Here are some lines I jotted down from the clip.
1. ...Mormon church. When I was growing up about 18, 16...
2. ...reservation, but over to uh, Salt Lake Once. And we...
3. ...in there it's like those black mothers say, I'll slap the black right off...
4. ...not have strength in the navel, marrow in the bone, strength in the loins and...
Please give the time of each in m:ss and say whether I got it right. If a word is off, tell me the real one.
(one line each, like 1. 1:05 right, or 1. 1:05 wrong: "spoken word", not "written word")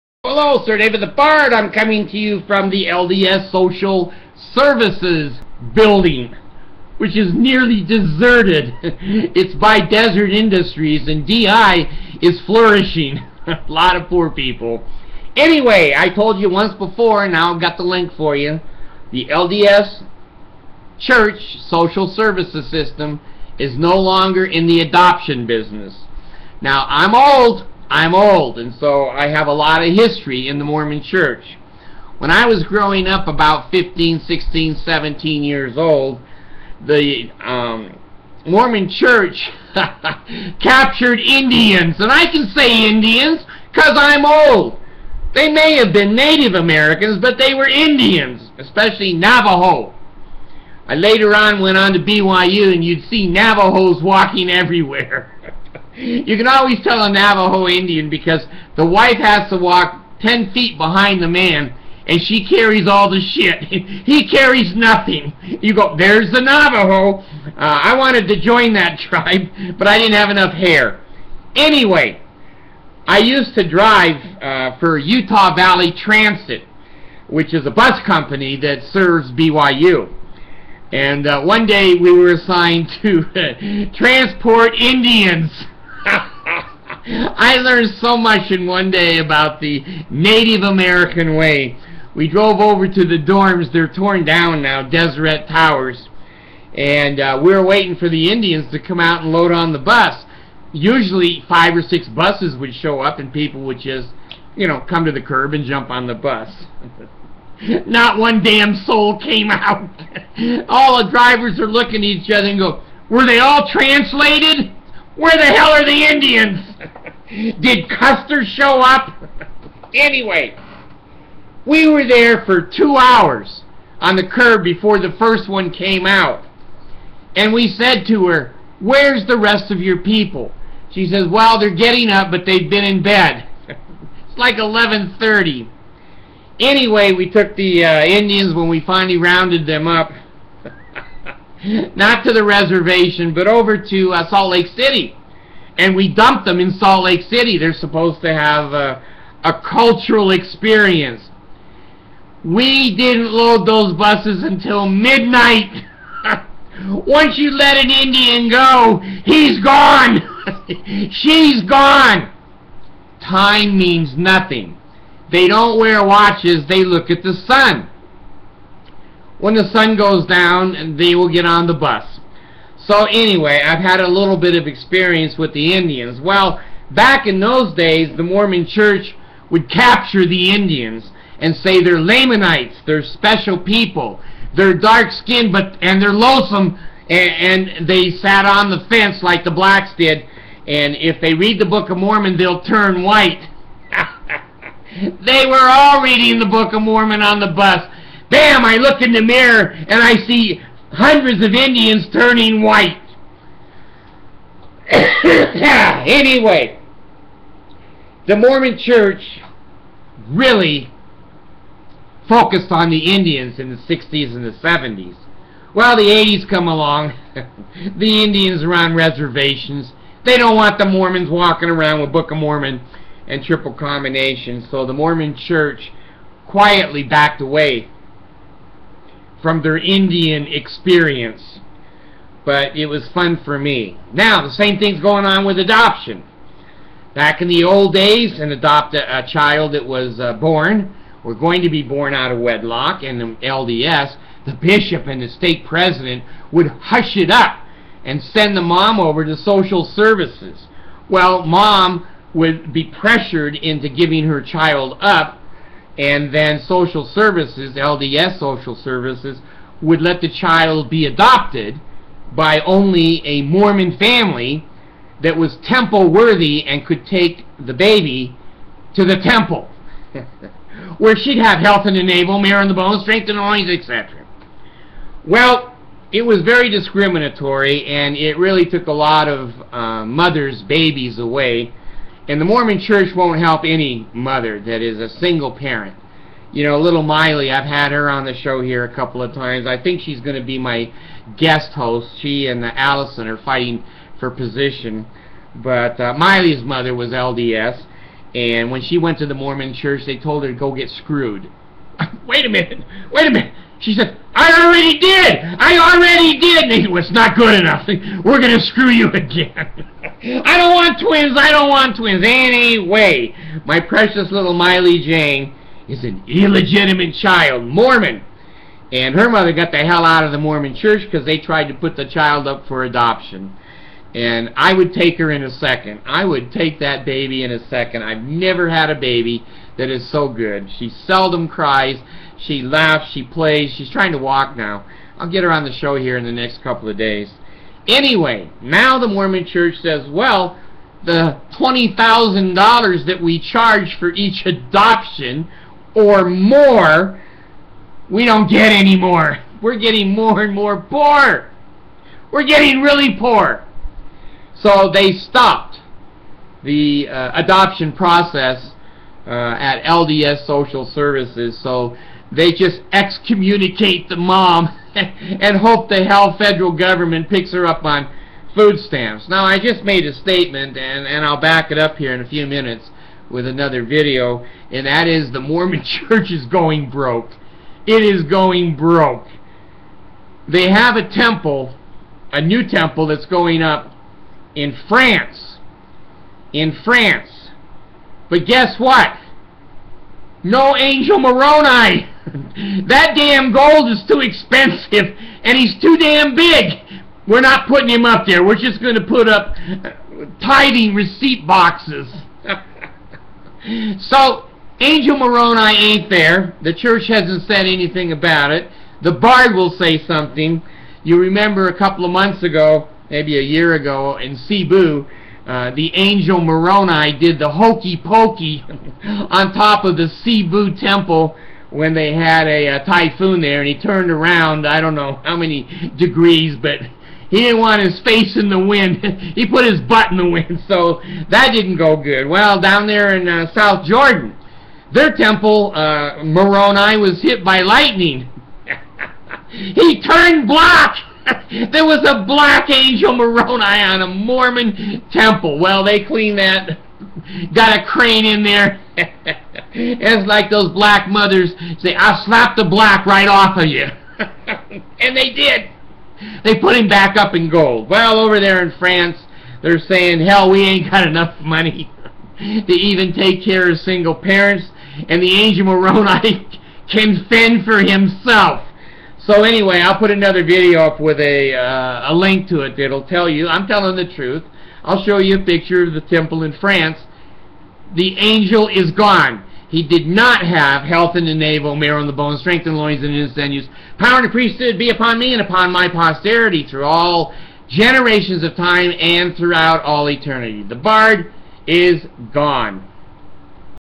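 1. 0:30 wrong: "15", not "18"
2. 2:22 wrong: "City", not "Once"
3. 7:28 right
4. 8:00 wrong: "health", not "strength".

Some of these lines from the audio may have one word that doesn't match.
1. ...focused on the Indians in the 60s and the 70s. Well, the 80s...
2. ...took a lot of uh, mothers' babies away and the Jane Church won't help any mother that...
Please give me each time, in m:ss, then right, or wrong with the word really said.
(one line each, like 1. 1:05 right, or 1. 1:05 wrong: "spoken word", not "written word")
1. 3:32 right
2. 4:38 wrong: "Mormon", not "Jane".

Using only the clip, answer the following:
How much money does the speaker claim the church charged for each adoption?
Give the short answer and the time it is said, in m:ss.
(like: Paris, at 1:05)
$20,000, at 5:41.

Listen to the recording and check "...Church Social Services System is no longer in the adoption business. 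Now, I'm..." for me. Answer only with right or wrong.
right.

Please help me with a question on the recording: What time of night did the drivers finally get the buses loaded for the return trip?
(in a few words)
midnight.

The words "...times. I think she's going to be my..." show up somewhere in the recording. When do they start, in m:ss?
4:49.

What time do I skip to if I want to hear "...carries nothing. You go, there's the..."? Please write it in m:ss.
1:04.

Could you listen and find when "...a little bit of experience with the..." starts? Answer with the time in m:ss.
2:53.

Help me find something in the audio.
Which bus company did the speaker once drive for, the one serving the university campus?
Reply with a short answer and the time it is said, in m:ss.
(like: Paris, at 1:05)
Utah Valley Transit, at 1:14.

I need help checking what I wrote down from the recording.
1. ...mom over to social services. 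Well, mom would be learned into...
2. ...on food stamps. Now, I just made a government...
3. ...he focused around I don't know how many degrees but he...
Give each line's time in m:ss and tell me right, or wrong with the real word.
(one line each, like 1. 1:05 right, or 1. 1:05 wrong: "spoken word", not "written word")
1. 4:08 wrong: "pressured", not "learned"
2. 6:07 wrong: "statement", not "government"
3. 7:03 wrong: "turned", not "focused".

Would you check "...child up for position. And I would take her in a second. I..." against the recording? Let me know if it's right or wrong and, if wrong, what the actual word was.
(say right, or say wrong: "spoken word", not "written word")
wrong: "adoption", not "position".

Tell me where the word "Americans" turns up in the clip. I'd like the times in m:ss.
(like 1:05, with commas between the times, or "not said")
0:46, 1:30.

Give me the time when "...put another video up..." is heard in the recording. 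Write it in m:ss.
7:49.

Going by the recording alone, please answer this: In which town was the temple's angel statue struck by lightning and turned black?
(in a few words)
South Jordan.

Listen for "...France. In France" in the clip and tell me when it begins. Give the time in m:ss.
6:24.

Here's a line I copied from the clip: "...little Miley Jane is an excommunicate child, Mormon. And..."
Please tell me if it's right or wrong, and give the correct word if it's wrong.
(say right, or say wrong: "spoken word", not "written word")
wrong: "illegitimate", not "excommunicate".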